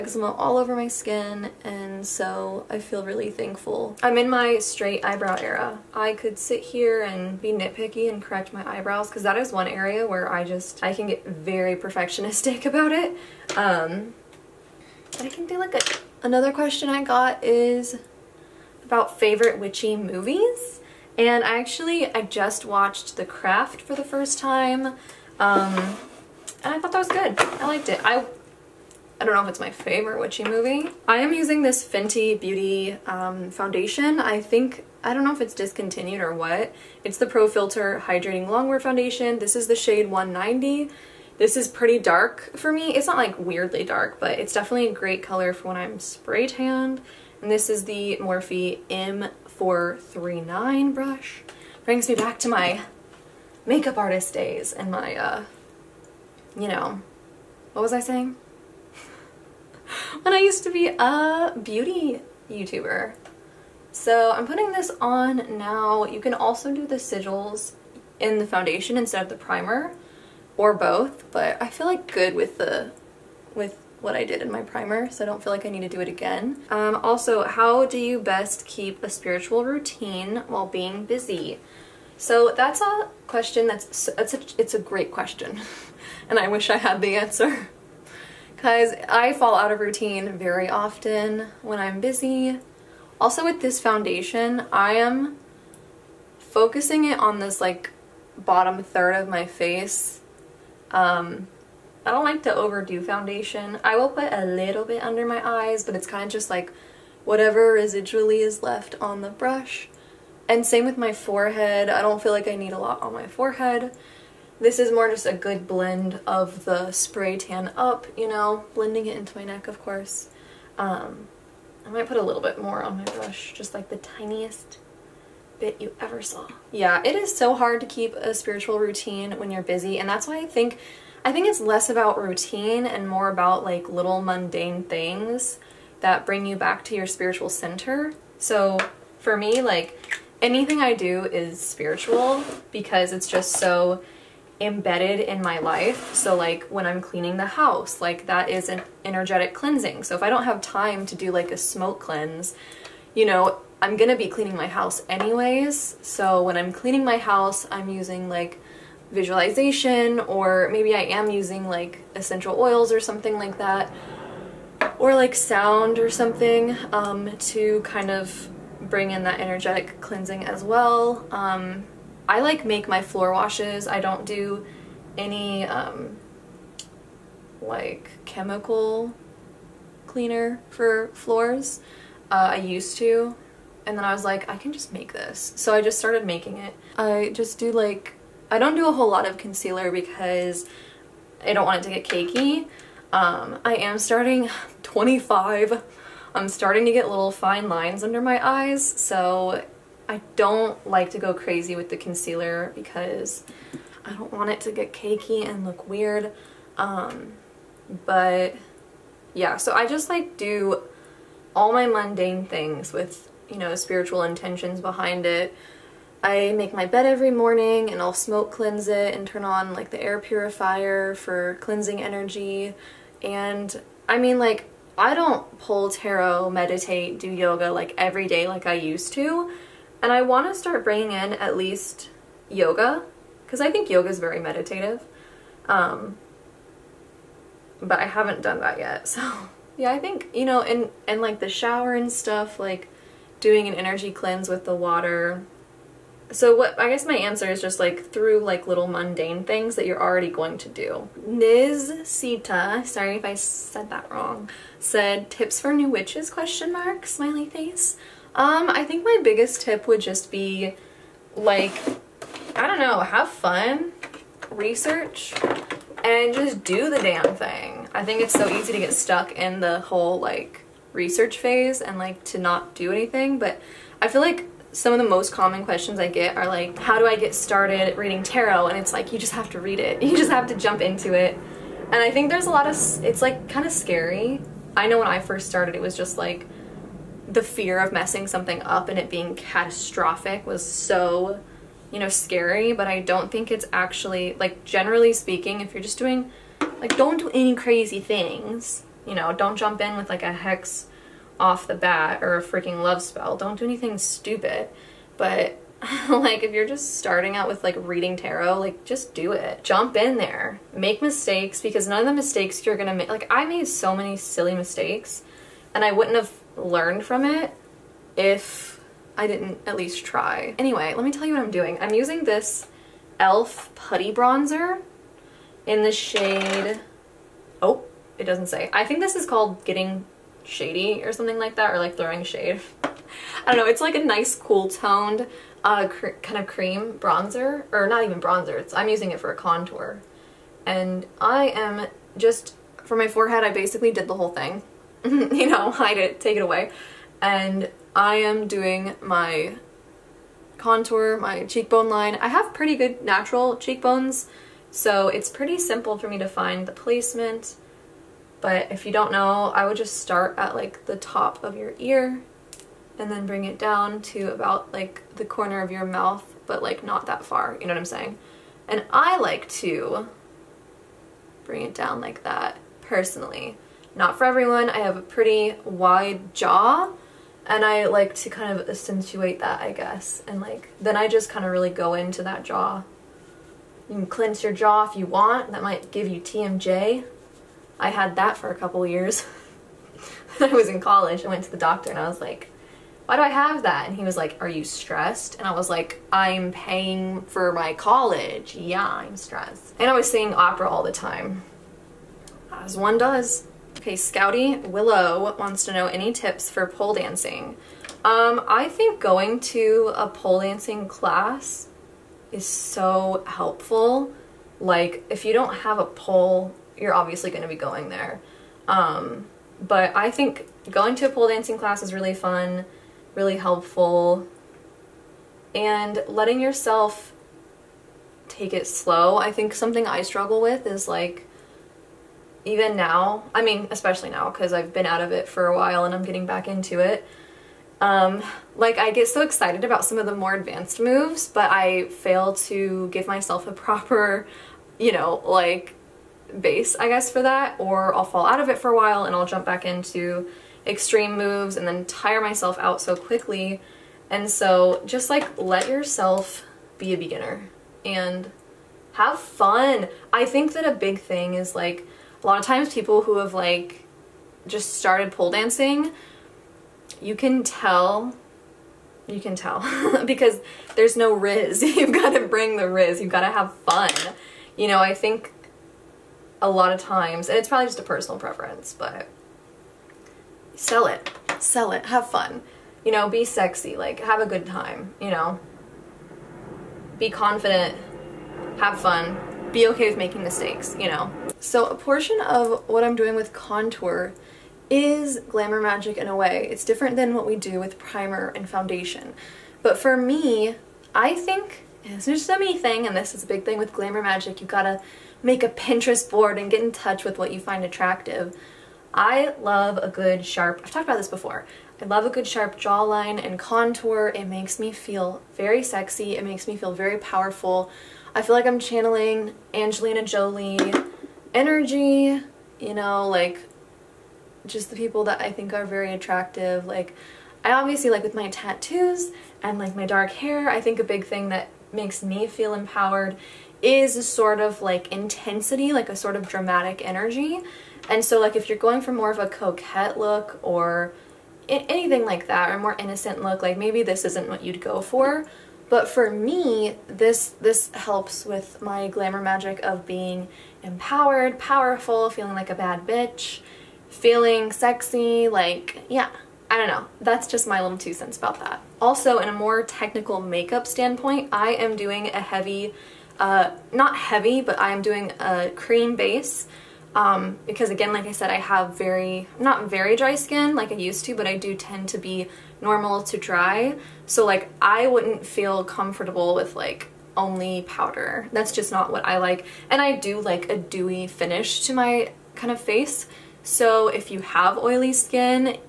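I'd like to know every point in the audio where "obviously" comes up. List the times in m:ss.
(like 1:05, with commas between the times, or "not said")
6:56, 8:47.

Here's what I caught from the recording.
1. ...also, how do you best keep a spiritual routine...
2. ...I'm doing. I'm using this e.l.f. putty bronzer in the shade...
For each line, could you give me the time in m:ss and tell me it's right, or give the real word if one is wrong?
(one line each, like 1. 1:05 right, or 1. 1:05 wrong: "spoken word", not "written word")
1. 1:16 right
2. 5:21 right.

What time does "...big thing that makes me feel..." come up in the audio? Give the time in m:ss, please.
8:50.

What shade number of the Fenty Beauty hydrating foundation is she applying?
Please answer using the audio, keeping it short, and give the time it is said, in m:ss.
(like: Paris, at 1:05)
190, at 0:40.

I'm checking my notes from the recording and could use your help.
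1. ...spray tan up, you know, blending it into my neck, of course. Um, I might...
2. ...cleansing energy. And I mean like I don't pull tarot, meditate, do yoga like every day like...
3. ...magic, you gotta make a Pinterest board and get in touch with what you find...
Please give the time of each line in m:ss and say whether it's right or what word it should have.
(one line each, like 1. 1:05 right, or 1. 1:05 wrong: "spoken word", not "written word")
1. 1:56 right
2. 3:41 right
3. 8:24 right.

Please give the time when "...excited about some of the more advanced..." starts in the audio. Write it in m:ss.
7:19.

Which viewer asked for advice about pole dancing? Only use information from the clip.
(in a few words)
Scouty Willow.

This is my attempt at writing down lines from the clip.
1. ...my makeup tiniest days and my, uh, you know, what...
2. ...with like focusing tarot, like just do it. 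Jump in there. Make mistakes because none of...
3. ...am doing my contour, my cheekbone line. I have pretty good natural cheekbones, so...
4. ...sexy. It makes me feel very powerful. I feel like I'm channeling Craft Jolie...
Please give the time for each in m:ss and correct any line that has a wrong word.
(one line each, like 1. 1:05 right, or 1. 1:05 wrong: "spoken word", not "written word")
1. 0:52 wrong: "artist", not "tiniest"
2. 5:07 wrong: "reading", not "focusing"
3. 5:48 right
4. 8:35 wrong: "Angelina", not "Craft".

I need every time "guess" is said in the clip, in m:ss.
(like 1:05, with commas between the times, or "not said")
4:06, 6:19, 7:26.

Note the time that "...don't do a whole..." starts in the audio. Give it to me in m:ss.
3:08.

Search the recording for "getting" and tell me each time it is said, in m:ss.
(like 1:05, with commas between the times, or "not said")
5:29, 7:16.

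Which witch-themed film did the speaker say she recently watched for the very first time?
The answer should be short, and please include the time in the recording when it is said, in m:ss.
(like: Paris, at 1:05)
The Craft, at 0:23.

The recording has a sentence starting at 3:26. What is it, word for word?
Um, but yeah, so I just like do all my mundane things with, you know, spiritual intentions behind it.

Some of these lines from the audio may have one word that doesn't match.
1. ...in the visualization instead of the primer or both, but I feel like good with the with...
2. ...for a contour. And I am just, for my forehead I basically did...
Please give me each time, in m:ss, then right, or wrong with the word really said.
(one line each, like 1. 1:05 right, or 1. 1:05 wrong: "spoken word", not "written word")
1. 1:08 wrong: "foundation", not "visualization"
2. 5:39 right.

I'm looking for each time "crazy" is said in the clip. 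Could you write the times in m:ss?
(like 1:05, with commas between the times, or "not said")
3:21, 4:57.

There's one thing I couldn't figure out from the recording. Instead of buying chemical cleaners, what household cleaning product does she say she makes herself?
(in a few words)
Floor washes.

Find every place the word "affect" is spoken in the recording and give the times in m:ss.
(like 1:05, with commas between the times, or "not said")
not said.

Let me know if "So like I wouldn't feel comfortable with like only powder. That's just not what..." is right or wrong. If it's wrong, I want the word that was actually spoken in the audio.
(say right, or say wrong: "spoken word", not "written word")
right.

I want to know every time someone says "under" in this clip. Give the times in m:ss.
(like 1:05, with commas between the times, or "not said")
1:45, 3:18.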